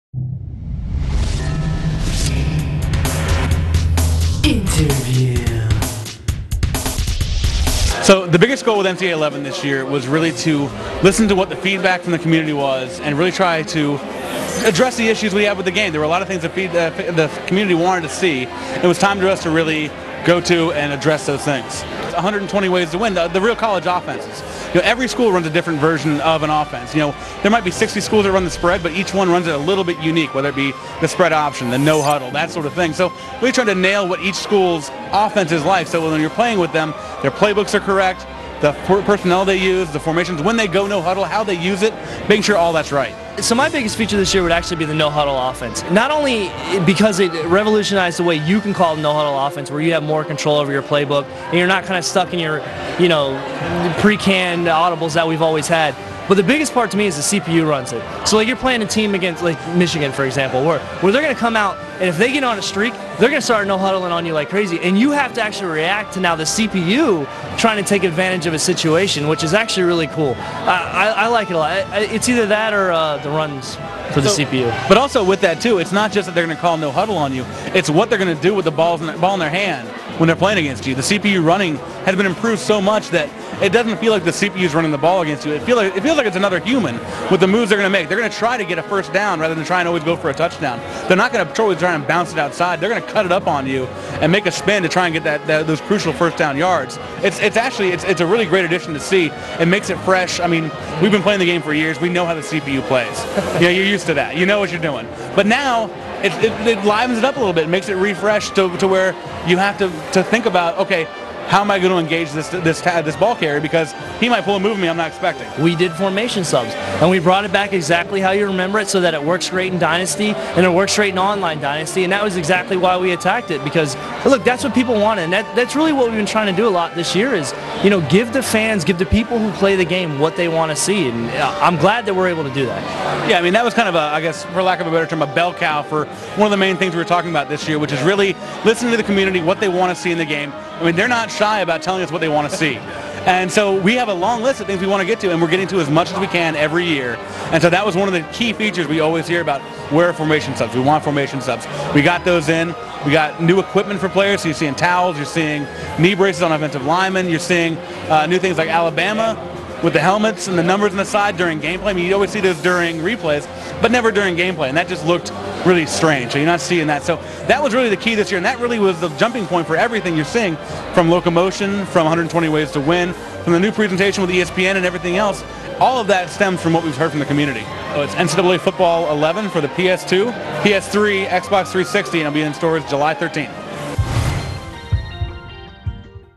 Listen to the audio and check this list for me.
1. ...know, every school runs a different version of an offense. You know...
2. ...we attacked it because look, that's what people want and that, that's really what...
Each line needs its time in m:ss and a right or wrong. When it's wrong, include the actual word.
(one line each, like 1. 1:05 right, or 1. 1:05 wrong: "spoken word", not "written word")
1. 0:24 right
2. 2:02 right.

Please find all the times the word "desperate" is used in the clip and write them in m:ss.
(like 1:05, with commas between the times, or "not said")
not said.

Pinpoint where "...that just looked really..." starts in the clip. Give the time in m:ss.
2:44.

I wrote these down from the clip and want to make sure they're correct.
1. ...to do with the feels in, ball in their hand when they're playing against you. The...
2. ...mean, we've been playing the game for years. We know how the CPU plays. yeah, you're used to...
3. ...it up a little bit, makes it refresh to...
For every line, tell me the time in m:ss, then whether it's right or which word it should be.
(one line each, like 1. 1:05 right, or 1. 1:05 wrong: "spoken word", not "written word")
1. 1:18 wrong: "balls", not "feels"
2. 1:40 right
3. 1:47 right.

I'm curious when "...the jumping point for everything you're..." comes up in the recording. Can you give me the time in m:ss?
2:49.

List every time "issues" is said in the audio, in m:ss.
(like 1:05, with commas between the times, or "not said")
0:15.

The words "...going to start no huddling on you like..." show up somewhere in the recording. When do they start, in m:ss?
1:03.